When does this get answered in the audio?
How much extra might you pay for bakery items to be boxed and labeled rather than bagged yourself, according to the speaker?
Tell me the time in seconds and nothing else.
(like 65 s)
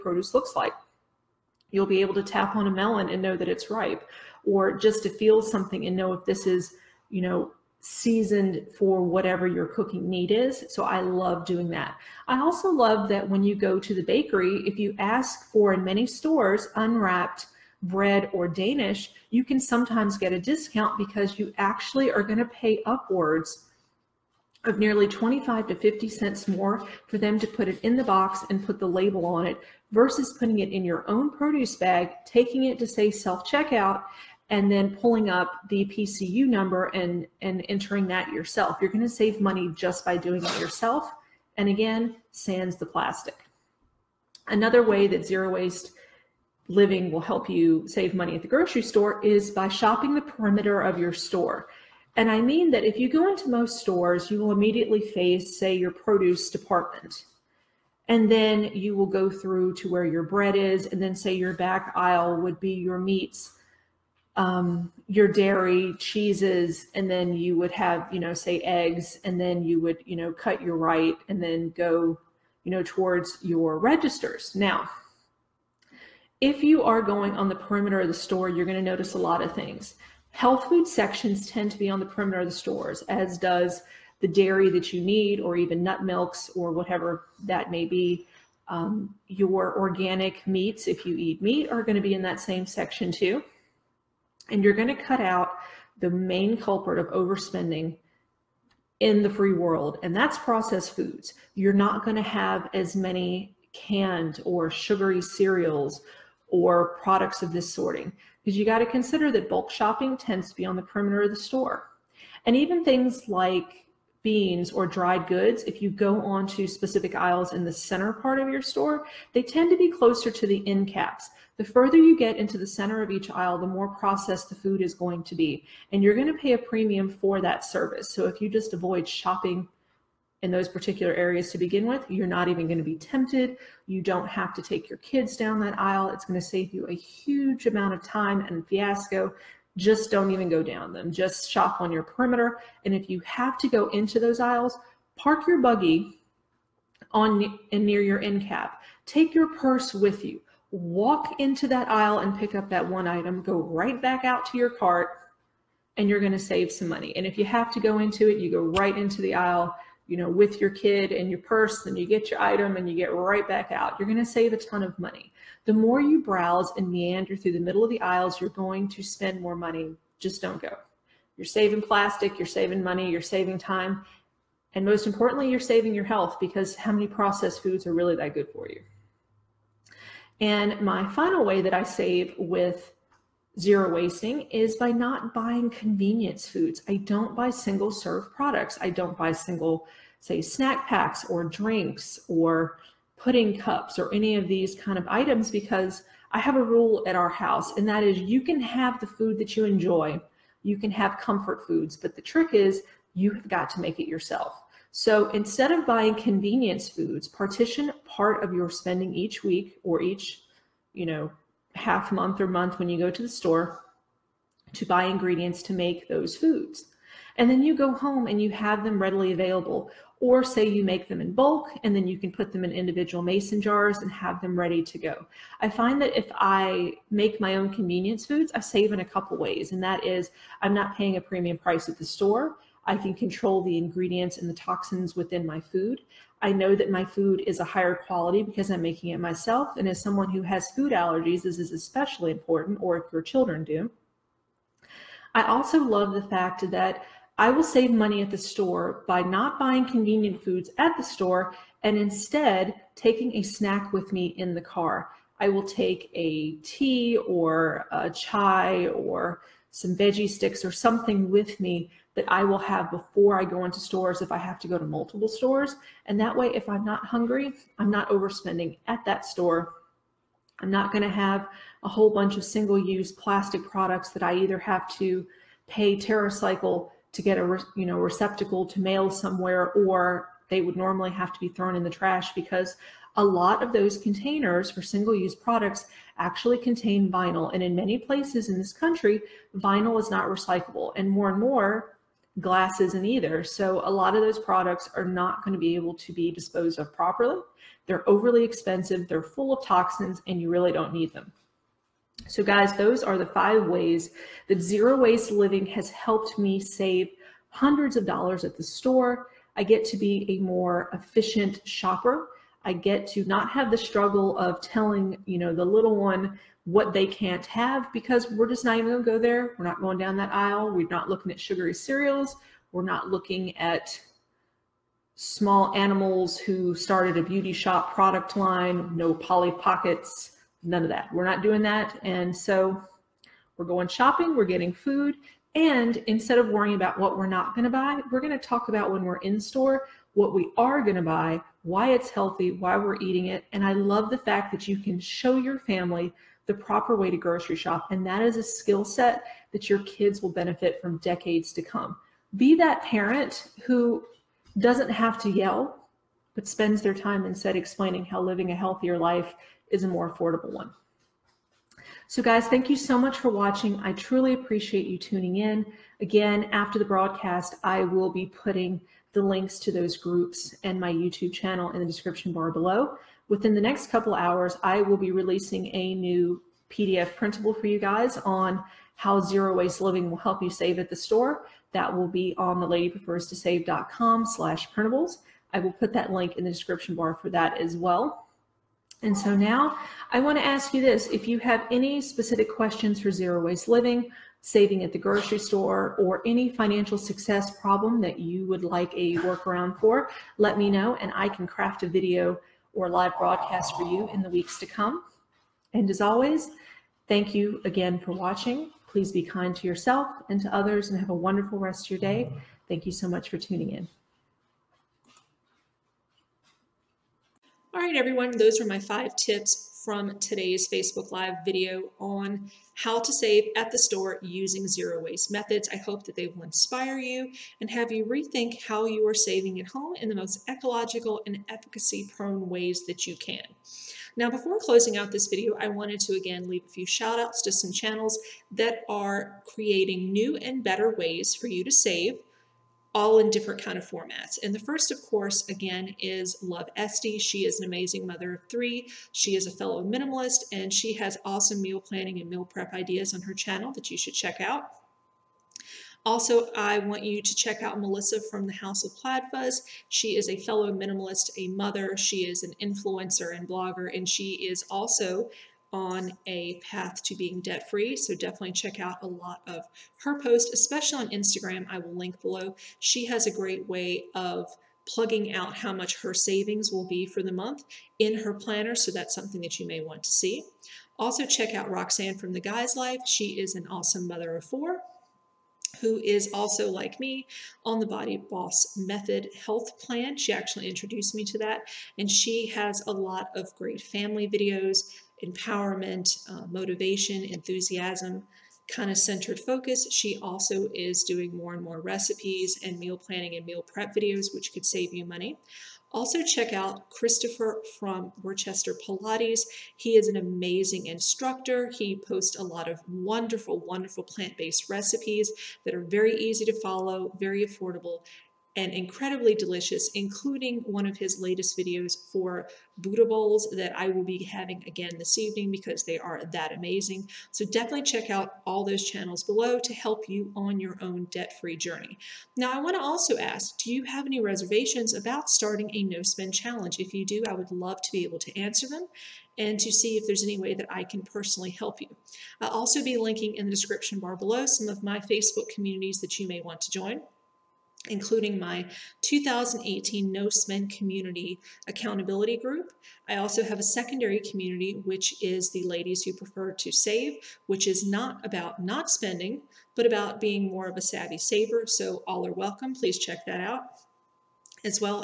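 25 s.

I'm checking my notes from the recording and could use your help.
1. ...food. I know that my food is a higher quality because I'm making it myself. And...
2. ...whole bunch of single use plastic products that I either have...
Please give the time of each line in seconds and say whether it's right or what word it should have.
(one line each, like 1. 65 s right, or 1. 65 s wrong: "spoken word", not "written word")
1. 235 s right
2. 271 s right.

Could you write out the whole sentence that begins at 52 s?
And I mean that if you go into most stores, you will immediately face, say, your produce department.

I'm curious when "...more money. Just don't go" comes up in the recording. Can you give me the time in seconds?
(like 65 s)
169 s.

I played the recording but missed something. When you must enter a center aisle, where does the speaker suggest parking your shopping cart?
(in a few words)
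near your end cap.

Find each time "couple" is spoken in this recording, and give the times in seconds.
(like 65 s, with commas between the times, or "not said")
229 s, 373 s.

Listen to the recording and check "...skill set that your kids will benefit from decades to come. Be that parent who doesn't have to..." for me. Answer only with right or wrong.
right.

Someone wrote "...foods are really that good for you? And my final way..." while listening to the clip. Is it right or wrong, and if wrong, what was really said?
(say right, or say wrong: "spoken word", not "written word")
right.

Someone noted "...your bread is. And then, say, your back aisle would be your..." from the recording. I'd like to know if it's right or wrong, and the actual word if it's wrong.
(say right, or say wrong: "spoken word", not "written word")
right.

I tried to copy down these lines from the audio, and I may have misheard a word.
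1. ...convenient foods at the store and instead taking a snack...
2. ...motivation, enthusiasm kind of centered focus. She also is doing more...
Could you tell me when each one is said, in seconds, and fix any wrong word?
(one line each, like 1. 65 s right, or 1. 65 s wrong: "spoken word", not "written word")
1. 249 s right
2. 496 s right.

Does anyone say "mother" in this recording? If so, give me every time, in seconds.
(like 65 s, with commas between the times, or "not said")
448 s, 461 s, 484 s.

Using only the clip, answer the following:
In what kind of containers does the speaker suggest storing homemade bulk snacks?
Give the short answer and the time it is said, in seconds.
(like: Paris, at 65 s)
mason jars, at 223 s.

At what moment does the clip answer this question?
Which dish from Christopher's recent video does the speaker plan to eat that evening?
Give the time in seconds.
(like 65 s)
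522 s.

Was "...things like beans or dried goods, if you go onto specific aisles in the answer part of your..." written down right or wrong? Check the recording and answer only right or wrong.
wrong.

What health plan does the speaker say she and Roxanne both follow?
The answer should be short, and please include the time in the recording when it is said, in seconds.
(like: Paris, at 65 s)
Body Boss Method, at 487 s.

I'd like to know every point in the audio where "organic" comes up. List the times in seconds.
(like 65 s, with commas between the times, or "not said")
89 s.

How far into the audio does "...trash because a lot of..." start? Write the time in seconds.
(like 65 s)
281 s.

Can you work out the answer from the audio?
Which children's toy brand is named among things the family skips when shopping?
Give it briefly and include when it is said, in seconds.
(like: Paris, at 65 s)
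Polly Pockets, at 329 s.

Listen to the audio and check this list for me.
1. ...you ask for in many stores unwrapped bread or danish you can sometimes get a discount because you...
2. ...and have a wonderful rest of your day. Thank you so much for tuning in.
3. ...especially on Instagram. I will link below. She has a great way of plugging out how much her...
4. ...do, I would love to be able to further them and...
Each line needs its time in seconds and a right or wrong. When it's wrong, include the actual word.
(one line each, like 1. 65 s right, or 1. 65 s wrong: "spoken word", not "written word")
1. 14 s right
2. 410 s right
3. 470 s right
4. 537 s wrong: "answer", not "further".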